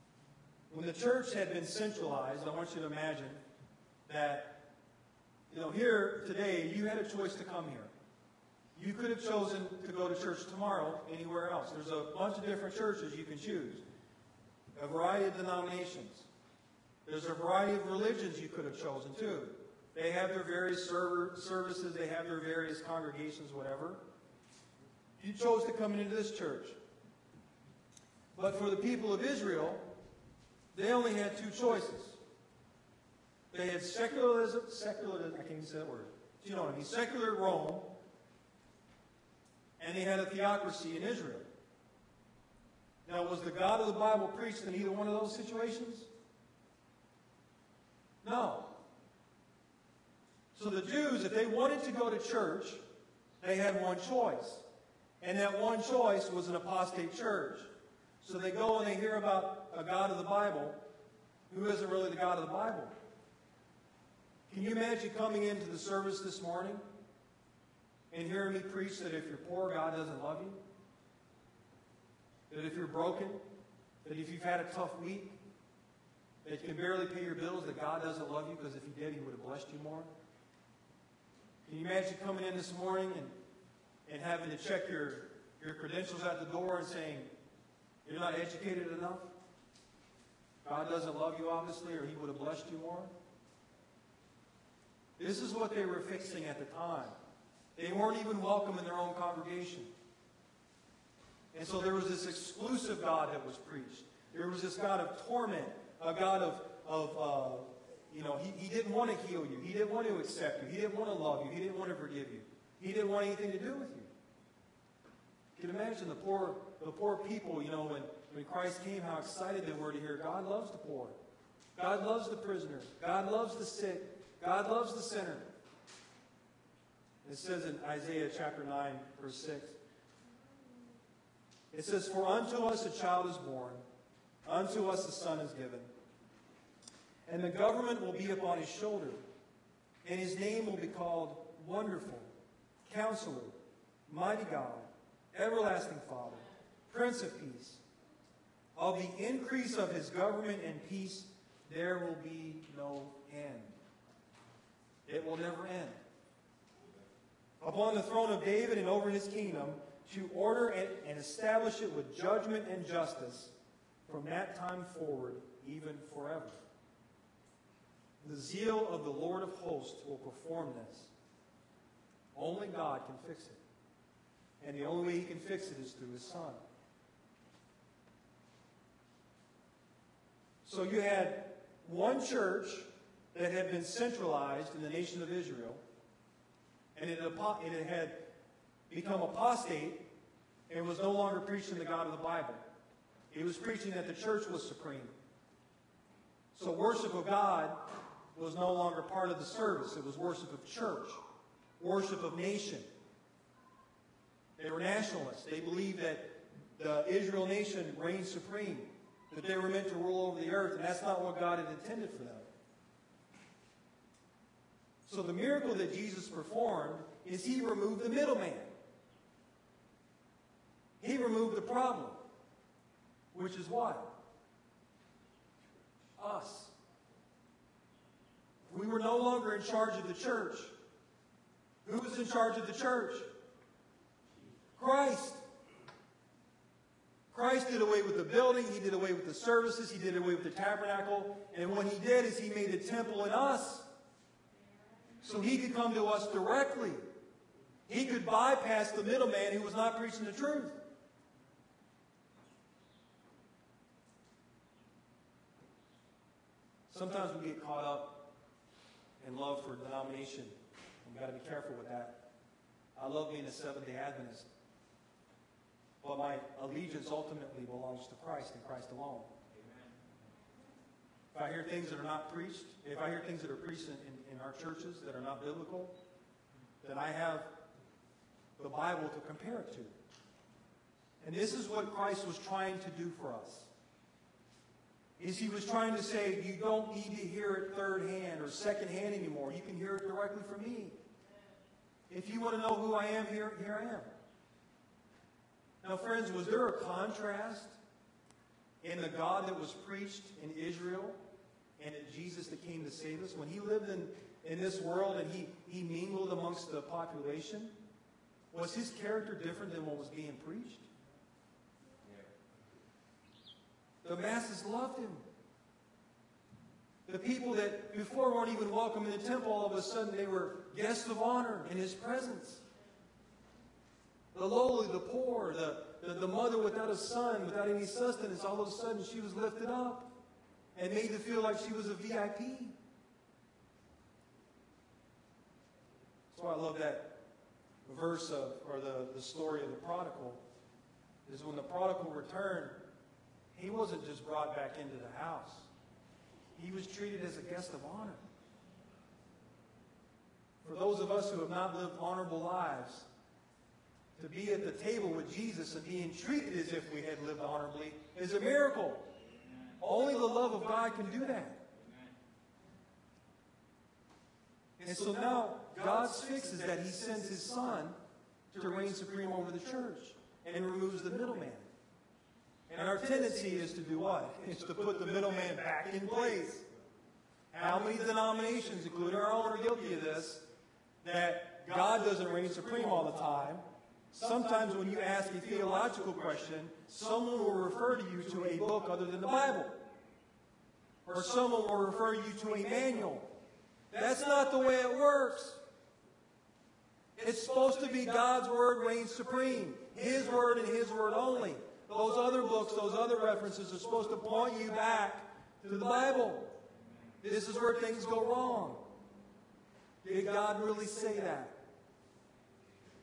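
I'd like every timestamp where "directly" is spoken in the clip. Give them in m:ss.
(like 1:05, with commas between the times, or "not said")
4:06, 4:50.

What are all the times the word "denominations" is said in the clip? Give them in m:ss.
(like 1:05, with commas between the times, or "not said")
0:15, 4:19, 6:17.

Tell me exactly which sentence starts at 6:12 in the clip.
And our tendency is to do what?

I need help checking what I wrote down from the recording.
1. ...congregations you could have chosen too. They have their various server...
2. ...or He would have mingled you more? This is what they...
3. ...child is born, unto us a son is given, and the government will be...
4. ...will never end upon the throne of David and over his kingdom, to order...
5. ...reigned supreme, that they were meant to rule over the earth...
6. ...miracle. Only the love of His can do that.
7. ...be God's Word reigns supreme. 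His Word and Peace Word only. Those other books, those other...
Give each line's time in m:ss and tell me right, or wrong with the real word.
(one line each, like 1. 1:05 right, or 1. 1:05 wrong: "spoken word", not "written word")
1. 0:17 wrong: "religions", not "congregations"
2. 1:31 wrong: "blessed", not "mingled"
3. 2:13 right
4. 2:35 right
5. 3:27 right
6. 5:58 wrong: "God", not "His"
7. 6:37 wrong: "His", not "Peace".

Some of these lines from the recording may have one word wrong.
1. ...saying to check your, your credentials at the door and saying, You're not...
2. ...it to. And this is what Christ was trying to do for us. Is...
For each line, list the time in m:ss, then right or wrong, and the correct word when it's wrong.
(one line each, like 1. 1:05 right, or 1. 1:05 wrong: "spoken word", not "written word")
1. 1:24 wrong: "having", not "saying"
2. 4:39 right.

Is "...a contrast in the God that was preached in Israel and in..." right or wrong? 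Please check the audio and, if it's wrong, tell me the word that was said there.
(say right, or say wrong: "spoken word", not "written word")
right.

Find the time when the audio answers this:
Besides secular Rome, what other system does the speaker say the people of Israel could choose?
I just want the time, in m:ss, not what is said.
0:40.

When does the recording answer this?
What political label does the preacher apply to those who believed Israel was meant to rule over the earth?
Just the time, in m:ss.
3:24.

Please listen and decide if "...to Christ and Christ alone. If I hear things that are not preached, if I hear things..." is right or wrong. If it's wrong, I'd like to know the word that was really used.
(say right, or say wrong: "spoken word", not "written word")
right.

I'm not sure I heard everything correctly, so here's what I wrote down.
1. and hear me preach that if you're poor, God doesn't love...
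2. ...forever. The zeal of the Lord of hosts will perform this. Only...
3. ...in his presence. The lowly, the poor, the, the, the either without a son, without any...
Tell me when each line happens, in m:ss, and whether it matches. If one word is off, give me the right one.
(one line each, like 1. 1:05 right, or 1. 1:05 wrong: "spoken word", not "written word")
1. 1:08 right
2. 2:46 right
3. 5:21 wrong: "mother", not "either".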